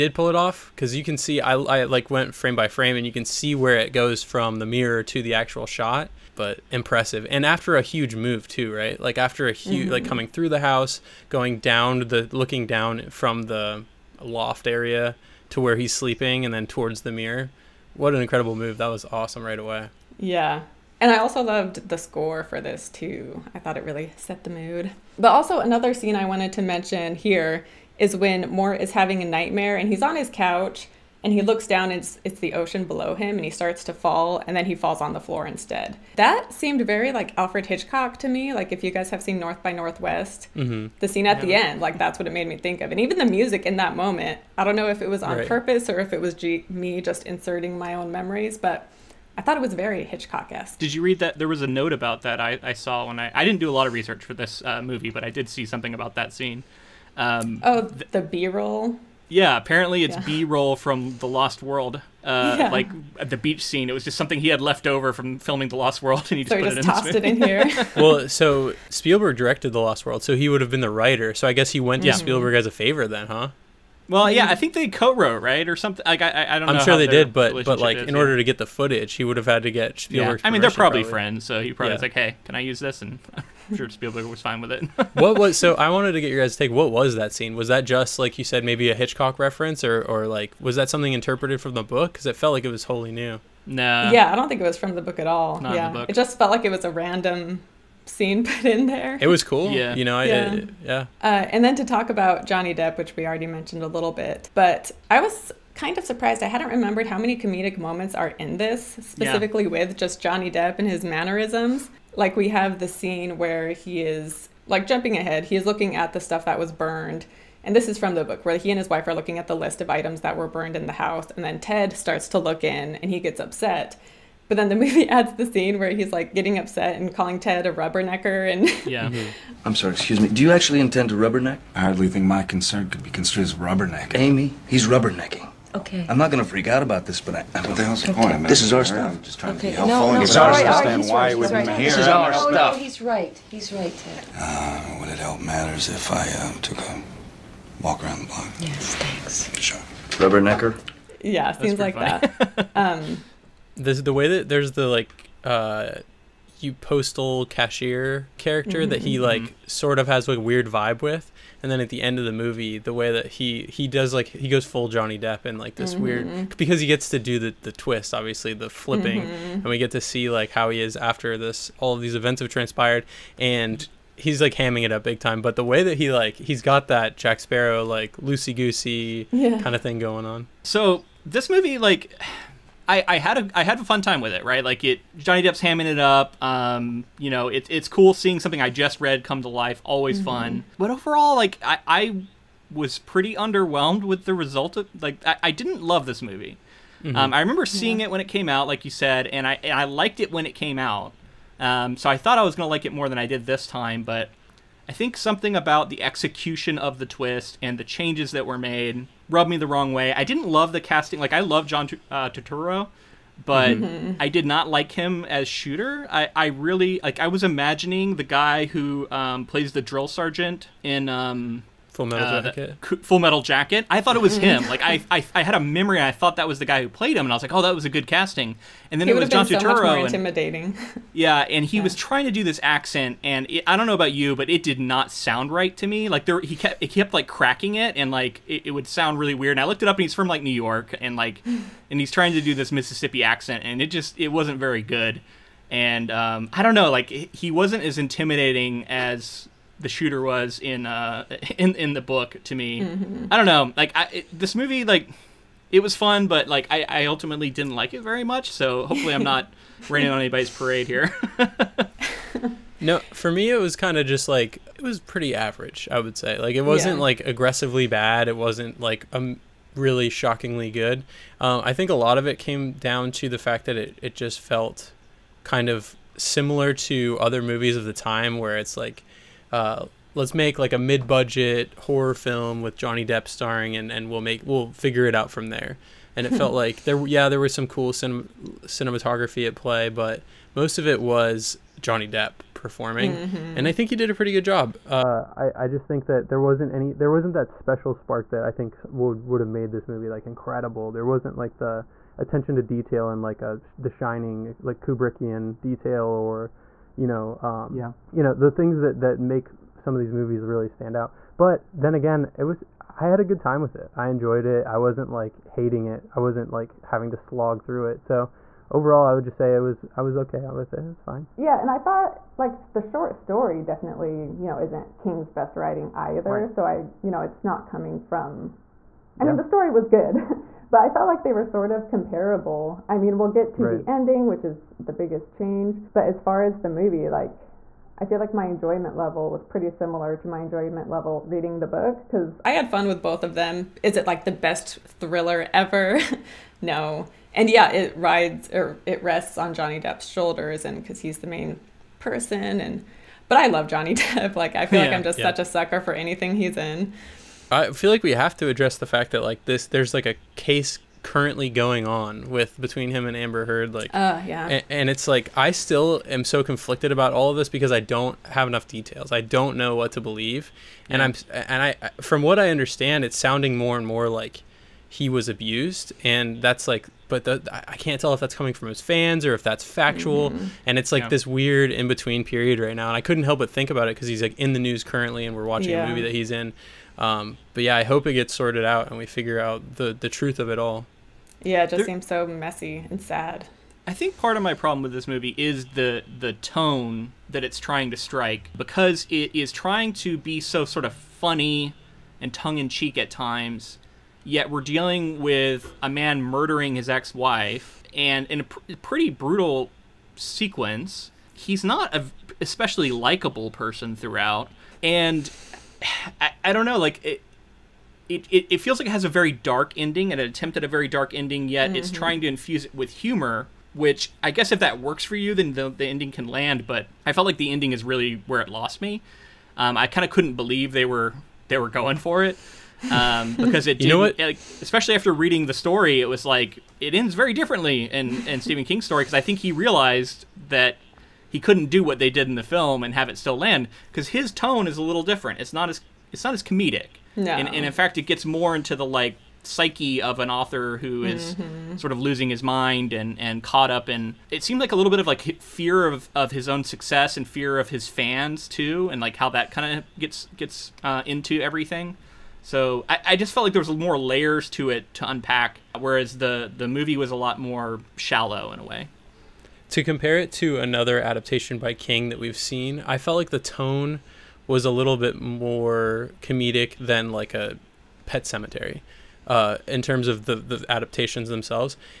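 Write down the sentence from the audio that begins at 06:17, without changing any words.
But the, I can't tell if that's coming from his fans or if that's factual, mm-hmm.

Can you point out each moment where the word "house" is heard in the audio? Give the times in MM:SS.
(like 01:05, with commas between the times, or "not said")
00:10, 02:00.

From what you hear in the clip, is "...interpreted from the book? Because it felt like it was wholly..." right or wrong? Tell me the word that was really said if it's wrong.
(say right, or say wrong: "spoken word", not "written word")
right.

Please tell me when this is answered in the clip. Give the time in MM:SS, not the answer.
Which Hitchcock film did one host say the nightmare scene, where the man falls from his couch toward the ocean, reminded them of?
00:39.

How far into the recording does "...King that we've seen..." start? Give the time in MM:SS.
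07:51.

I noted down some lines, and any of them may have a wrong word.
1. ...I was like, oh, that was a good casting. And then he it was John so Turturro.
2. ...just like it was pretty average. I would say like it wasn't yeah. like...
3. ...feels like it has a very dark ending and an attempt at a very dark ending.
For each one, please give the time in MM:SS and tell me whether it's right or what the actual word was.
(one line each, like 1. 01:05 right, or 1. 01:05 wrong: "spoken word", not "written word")
1. 03:47 right
2. 04:24 right
3. 06:58 right.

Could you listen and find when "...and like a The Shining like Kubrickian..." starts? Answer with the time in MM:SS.
05:03.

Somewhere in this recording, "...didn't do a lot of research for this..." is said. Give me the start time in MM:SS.
00:53.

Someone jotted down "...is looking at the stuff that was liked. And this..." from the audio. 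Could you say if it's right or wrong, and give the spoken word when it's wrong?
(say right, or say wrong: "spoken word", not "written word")
wrong: "burned", not "liked".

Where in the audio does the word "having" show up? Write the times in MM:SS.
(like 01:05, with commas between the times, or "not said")
00:28, 05:16.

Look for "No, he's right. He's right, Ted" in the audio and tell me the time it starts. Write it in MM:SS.
02:22.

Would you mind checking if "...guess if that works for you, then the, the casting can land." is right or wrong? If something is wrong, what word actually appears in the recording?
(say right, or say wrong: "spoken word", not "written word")
wrong: "ending", not "casting".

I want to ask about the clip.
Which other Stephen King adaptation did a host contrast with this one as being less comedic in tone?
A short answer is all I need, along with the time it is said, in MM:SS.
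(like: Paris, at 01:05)
Pet Sematary, at 07:58.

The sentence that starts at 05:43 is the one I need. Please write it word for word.
Is it like the best thriller ever?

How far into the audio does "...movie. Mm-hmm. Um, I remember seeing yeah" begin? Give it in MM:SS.
03:16.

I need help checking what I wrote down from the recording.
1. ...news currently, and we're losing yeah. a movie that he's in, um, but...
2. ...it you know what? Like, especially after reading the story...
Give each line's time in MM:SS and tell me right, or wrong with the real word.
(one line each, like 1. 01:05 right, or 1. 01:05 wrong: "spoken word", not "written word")
1. 06:24 wrong: "watching", not "losing"
2. 07:13 right.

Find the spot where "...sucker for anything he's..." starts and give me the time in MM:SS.
05:55.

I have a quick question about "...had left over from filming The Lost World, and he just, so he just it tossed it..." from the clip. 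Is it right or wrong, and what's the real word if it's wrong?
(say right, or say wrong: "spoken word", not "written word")
right.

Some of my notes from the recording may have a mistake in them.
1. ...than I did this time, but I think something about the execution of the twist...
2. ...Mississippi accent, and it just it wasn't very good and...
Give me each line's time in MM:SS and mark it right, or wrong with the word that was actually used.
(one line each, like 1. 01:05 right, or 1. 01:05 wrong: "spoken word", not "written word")
1. 03:23 right
2. 04:02 right.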